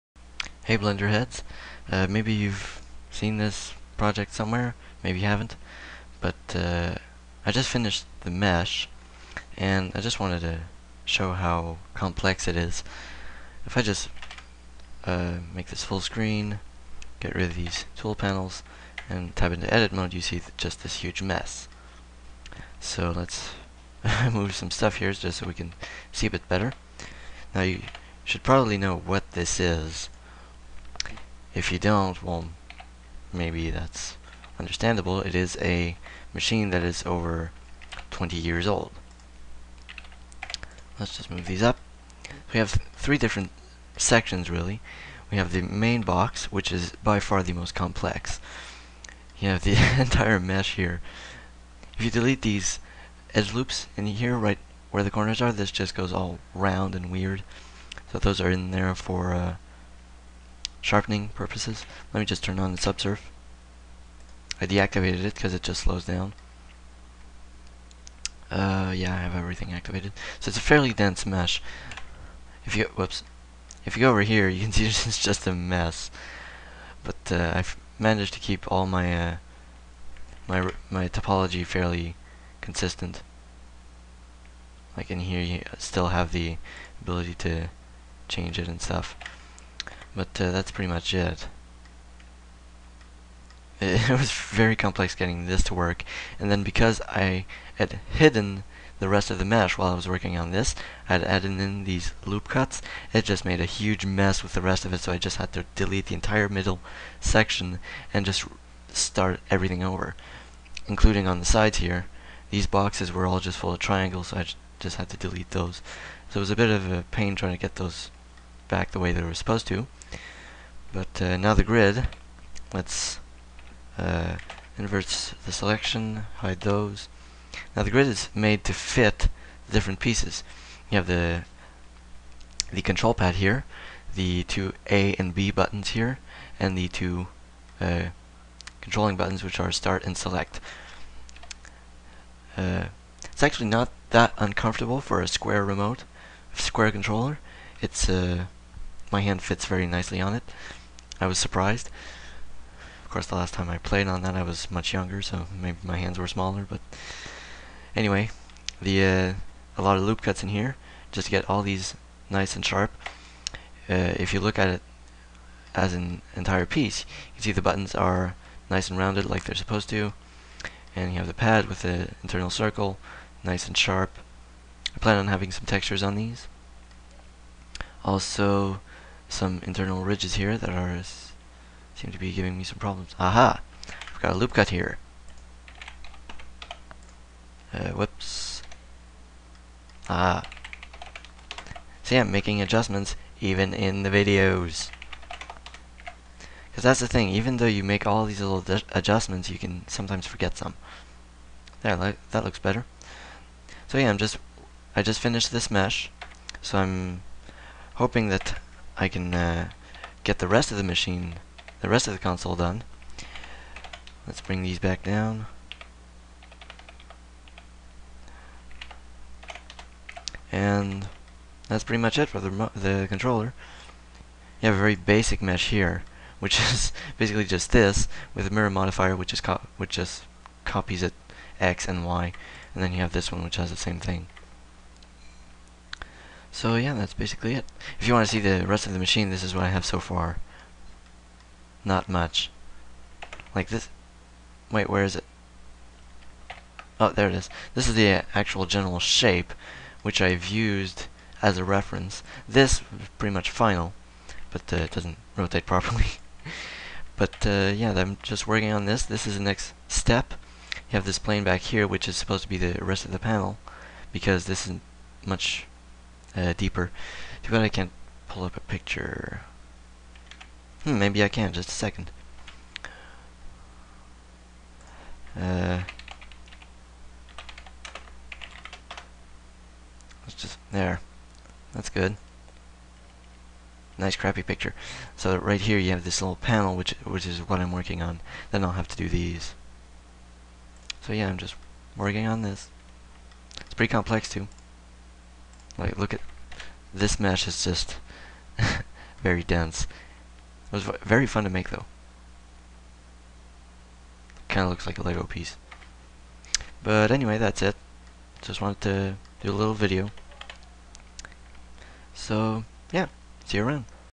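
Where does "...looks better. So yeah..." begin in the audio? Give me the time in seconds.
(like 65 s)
202 s.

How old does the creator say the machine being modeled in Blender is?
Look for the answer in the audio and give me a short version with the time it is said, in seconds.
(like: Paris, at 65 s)
Over 20 years, at 37 s.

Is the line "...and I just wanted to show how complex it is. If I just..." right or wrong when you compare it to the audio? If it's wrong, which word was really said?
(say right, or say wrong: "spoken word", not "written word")
right.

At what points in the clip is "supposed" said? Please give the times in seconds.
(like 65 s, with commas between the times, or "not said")
119 s, 169 s, 262 s.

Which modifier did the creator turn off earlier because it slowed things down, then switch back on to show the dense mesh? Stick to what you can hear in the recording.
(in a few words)
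Subsurf.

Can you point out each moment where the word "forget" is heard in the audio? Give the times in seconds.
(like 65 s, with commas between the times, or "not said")
200 s.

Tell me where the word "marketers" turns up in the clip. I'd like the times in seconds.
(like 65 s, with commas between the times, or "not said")
not said.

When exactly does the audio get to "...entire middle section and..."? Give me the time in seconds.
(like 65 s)
106 s.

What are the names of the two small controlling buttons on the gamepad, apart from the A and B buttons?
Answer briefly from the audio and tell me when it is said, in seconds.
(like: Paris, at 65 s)
Start and select, at 139 s.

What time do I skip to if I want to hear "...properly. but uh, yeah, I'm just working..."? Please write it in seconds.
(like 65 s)
255 s.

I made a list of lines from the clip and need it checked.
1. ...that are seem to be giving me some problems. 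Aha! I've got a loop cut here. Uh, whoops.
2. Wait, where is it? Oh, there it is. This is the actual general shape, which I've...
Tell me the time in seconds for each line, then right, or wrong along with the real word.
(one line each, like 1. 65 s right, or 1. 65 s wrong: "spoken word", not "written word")
1. 180 s right
2. 244 s right.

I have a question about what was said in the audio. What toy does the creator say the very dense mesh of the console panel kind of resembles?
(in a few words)
A Lego piece.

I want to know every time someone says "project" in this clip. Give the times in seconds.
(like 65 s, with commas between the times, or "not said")
3 s.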